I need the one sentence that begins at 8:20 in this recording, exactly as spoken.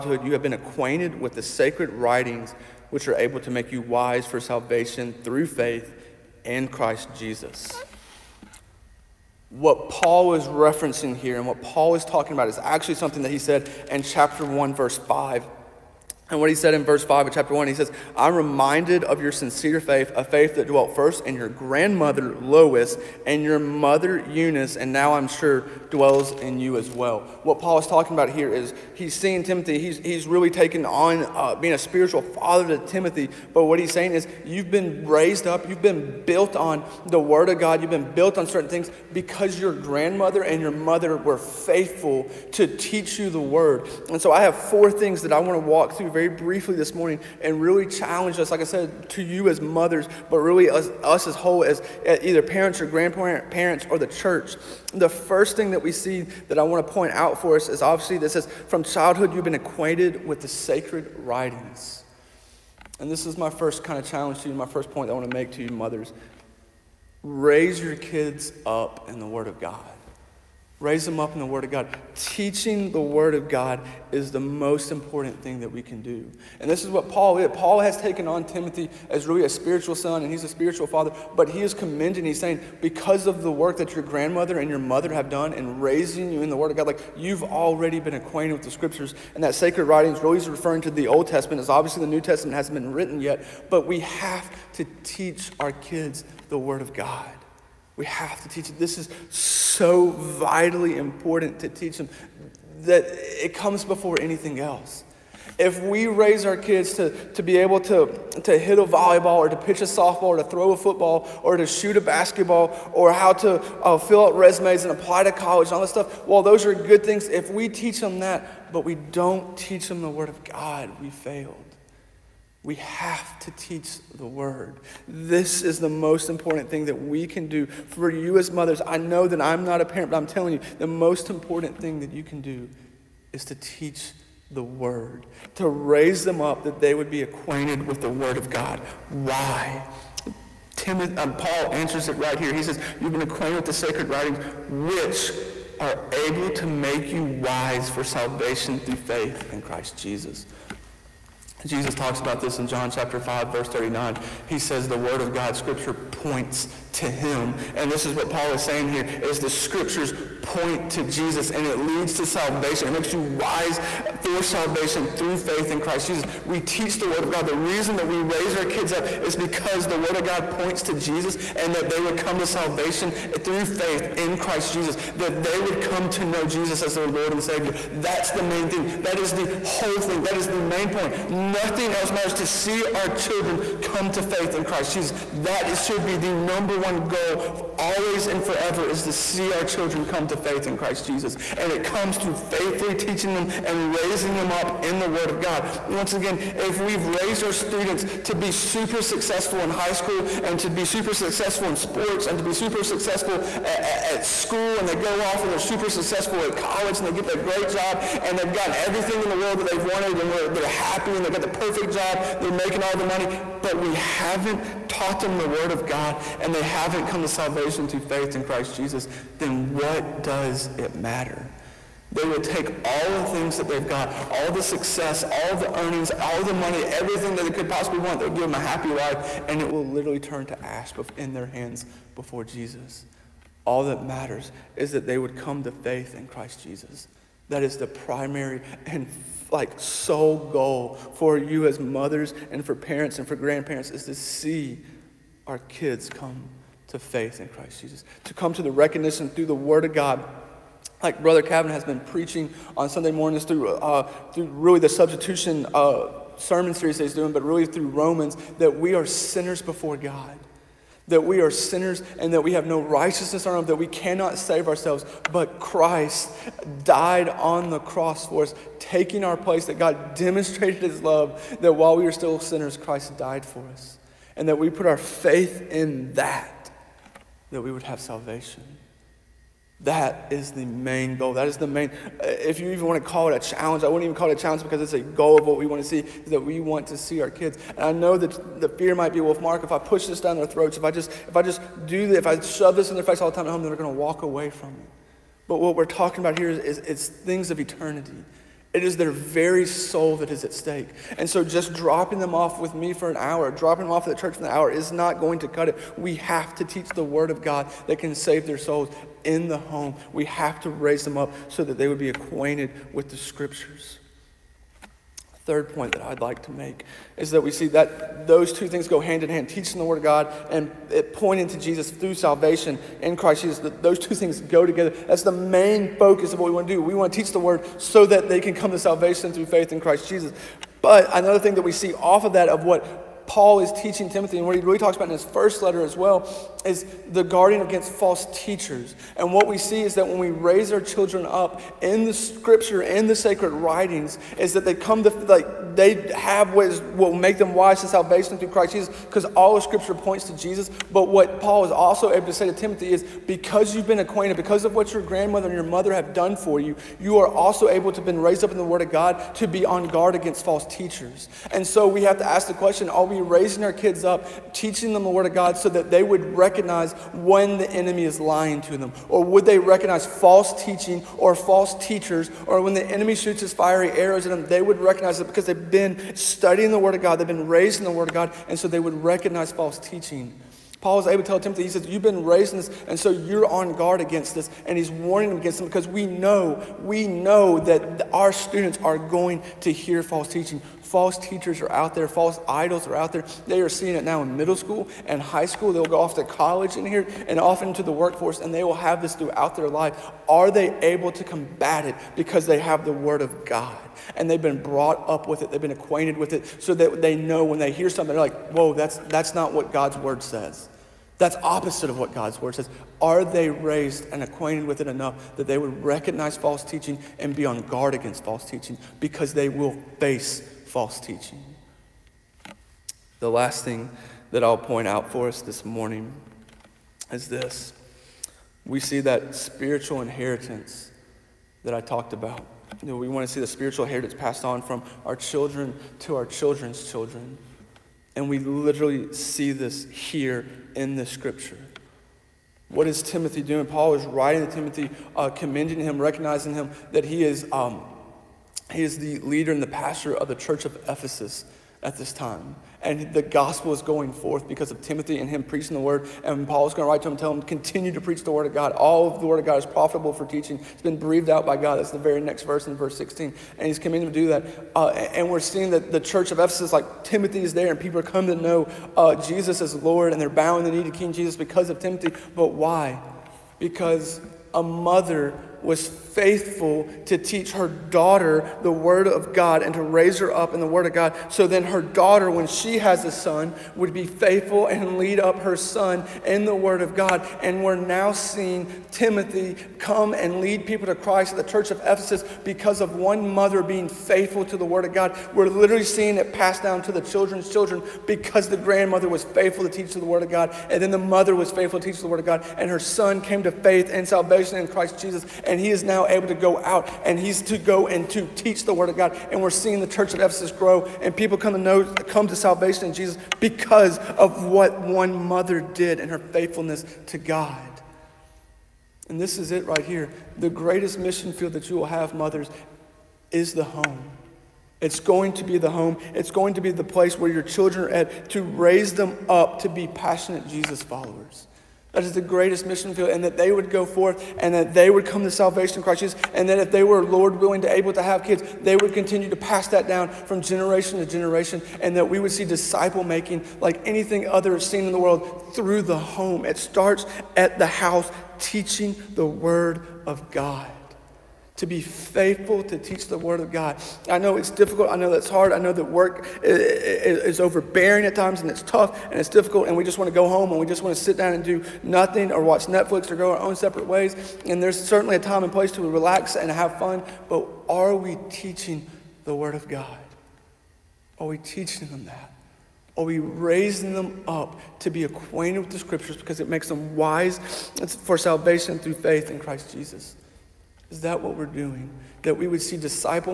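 And then the mother was faithful to teach the Word of God.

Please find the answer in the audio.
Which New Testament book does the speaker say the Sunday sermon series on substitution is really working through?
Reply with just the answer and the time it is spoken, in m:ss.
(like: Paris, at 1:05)
Romans, at 4:17.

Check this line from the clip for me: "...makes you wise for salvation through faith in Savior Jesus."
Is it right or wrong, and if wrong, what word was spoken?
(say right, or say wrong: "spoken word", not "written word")
wrong: "Christ", not "Savior".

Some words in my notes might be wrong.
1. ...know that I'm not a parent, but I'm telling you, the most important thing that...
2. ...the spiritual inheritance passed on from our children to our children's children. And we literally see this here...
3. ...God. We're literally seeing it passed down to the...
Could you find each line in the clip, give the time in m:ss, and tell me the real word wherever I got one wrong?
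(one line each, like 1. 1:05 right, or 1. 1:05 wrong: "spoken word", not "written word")
1. 2:08 right
2. 7:13 right
3. 8:14 right.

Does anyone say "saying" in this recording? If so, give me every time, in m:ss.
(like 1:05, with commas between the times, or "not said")
0:33, 1:22, 2:38.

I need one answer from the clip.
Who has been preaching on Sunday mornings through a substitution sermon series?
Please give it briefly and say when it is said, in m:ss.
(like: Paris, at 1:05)
Brother Calvin, at 4:11.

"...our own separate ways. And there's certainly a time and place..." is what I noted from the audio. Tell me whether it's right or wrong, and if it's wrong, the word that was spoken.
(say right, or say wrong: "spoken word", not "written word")
right.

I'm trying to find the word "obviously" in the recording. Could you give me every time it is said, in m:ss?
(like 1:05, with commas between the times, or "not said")
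0:57, 1:31.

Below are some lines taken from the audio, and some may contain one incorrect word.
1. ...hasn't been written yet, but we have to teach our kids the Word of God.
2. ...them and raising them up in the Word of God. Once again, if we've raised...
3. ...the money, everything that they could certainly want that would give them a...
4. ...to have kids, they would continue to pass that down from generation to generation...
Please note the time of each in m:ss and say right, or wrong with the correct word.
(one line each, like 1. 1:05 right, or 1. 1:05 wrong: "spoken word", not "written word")
1. 1:32 right
2. 3:13 right
3. 3:46 wrong: "possibly", not "certainly"
4. 8:57 right.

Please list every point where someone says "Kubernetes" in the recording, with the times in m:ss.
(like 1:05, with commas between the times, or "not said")
not said.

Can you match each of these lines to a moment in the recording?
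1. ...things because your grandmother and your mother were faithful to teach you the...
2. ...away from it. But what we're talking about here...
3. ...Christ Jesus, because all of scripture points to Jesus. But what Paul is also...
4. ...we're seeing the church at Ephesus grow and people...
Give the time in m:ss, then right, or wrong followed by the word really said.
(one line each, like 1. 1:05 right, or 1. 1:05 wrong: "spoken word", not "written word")
1. 0:38 right
2. 4:54 right
3. 5:48 right
4. 8:29 right.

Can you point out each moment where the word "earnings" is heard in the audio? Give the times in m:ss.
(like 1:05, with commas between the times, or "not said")
3:45.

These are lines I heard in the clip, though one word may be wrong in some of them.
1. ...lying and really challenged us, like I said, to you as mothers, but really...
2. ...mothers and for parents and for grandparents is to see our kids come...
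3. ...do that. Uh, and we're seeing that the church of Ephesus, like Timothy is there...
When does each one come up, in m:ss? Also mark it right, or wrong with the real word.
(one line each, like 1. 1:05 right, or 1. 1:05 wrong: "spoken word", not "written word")
1. 0:46 wrong: "morning", not "lying"
2. 4:01 right
3. 7:44 right.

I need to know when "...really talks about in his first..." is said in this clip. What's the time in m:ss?
5:34.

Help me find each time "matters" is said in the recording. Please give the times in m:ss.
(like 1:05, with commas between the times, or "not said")
3:02, 3:40, 3:54.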